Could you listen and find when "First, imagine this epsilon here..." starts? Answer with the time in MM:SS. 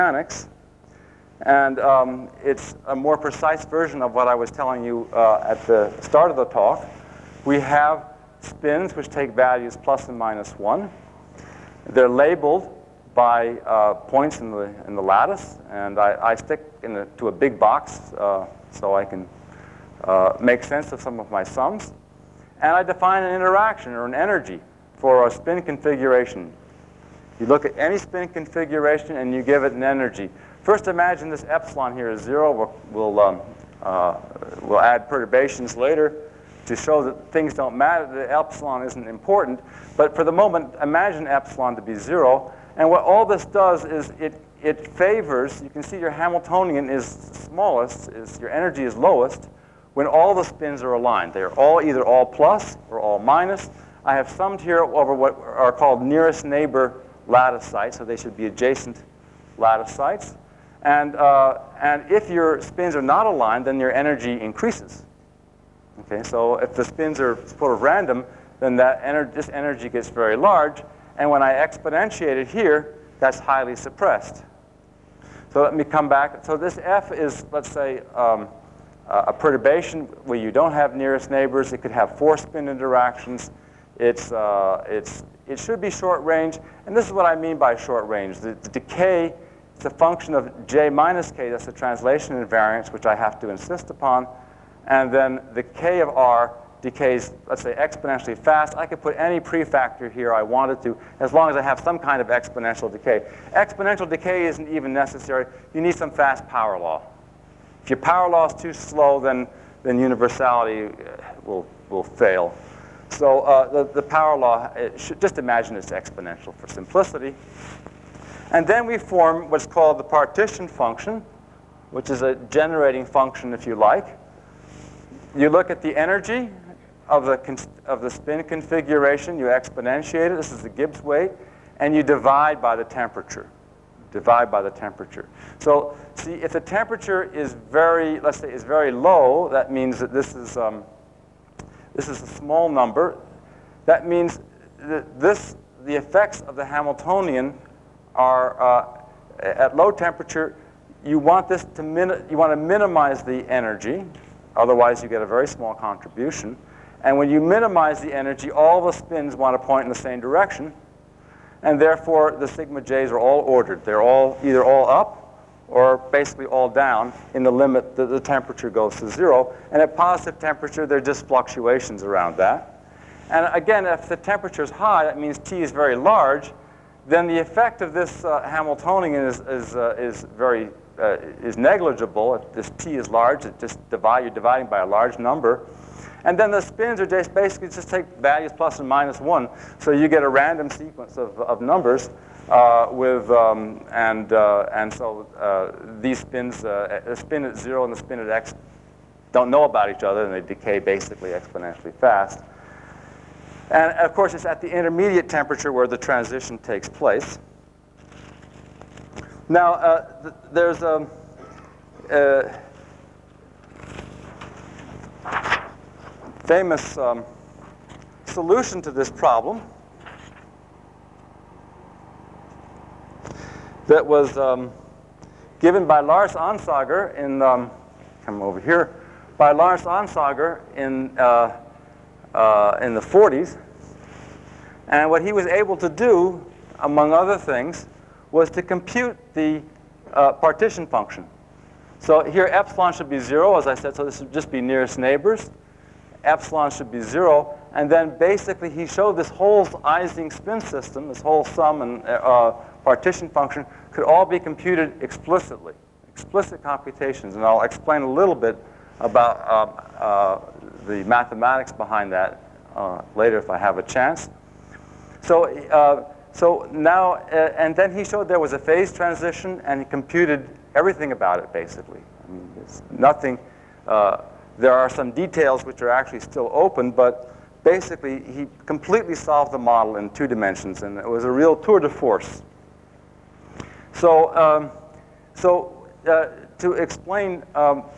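00:30.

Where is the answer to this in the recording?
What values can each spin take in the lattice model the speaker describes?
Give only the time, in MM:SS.
00:09.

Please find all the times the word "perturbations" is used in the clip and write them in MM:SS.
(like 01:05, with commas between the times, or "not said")
00:35, 01:19.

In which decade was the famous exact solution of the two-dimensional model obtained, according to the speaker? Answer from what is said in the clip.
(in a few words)
the 1940s.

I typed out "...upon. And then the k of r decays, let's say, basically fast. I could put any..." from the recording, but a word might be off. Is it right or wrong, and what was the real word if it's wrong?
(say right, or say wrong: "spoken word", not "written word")
wrong: "exponentially", not "basically".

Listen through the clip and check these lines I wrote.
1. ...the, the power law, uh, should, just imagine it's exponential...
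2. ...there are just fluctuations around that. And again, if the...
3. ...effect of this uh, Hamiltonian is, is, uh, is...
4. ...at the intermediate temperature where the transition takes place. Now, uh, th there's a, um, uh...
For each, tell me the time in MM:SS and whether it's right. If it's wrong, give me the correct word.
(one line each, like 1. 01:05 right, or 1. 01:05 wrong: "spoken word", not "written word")
1. 01:53 right
2. 02:50 right
3. 02:57 right
4. 03:24 right.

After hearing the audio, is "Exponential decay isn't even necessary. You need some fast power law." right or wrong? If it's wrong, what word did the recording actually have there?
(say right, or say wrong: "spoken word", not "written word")
right.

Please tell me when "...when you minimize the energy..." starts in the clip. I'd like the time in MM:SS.
02:37.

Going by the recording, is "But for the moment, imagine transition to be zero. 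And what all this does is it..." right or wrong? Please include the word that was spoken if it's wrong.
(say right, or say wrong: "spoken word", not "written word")
wrong: "epsilon", not "transition".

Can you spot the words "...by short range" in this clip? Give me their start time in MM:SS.
01:27.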